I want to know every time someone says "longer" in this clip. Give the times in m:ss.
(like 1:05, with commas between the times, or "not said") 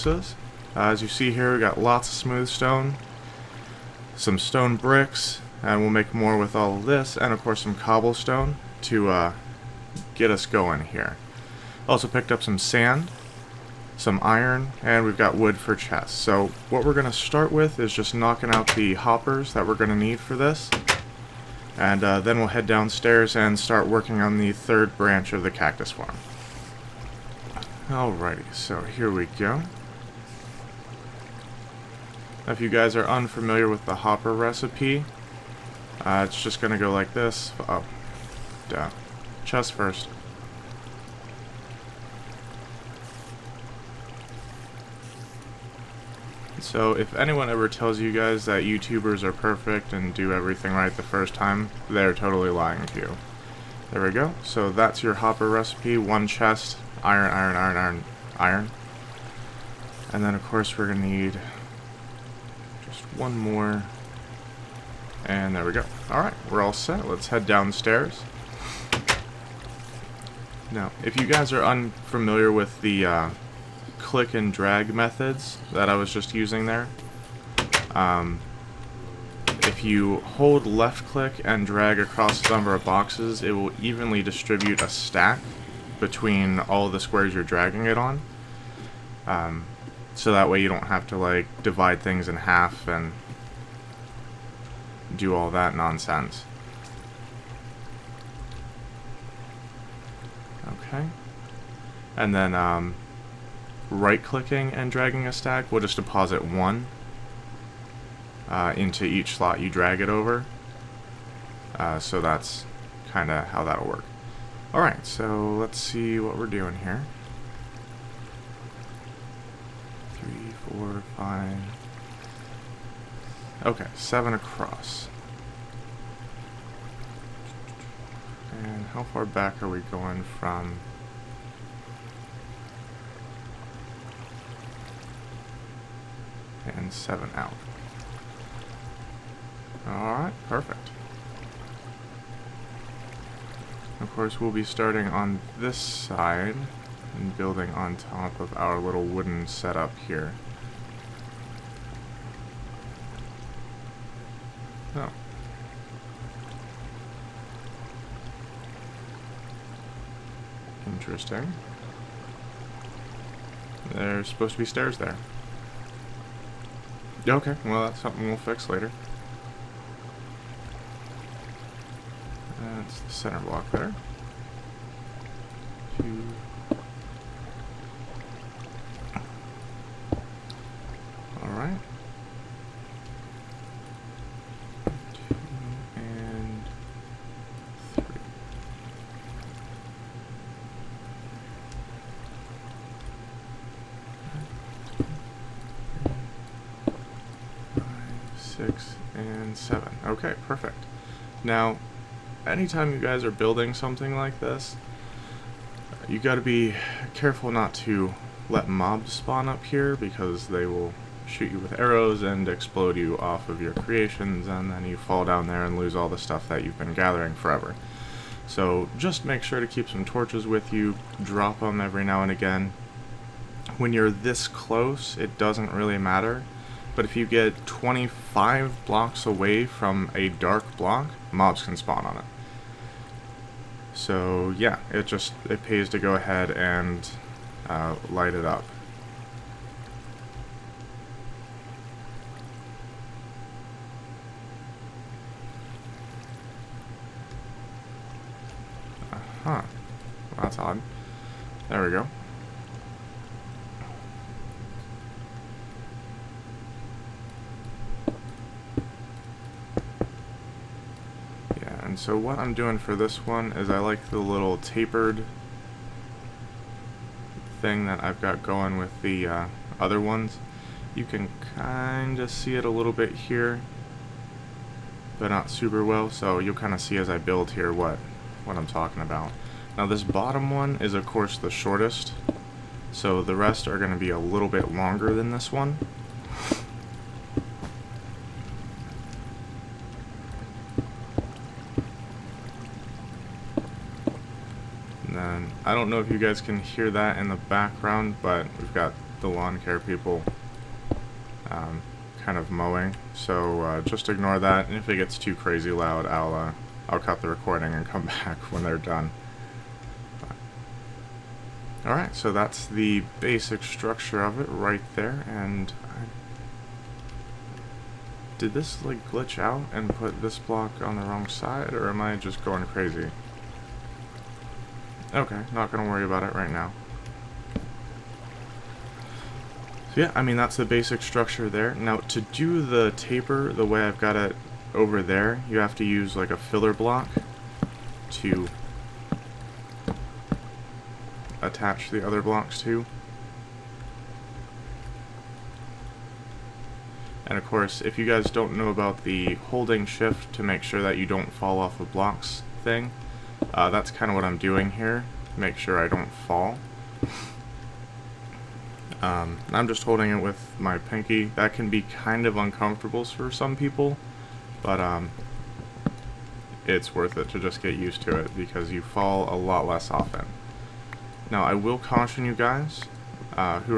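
4:44.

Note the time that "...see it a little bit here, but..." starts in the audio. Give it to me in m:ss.
4:32.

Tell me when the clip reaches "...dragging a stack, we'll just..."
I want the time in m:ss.
1:44.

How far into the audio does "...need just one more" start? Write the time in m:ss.
1:01.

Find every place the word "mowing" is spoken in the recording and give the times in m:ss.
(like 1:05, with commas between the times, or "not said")
5:02.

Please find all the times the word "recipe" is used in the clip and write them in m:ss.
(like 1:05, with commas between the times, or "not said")
0:34, 0:55.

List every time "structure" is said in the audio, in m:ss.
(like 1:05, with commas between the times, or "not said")
5:13, 5:31.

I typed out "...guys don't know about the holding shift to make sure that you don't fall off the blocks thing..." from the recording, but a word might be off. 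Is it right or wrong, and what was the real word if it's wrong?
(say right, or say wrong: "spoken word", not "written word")
right.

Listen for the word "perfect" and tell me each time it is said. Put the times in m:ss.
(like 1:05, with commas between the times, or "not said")
0:49, 2:20.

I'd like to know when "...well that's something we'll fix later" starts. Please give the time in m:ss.
2:47.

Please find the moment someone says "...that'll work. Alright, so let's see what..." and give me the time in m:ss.
1:53.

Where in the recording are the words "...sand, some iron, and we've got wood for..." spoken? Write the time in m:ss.
0:12.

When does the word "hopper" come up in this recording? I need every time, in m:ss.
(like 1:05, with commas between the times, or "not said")
0:18, 0:33, 0:55.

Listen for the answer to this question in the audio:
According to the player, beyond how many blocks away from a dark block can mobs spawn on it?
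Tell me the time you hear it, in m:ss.
3:47.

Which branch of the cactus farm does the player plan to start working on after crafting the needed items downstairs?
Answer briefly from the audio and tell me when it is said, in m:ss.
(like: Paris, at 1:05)
third, at 0:24.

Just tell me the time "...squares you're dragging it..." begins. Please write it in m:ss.
1:26.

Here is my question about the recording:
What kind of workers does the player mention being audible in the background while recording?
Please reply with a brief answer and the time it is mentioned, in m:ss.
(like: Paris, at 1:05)
lawn care people, at 4:59.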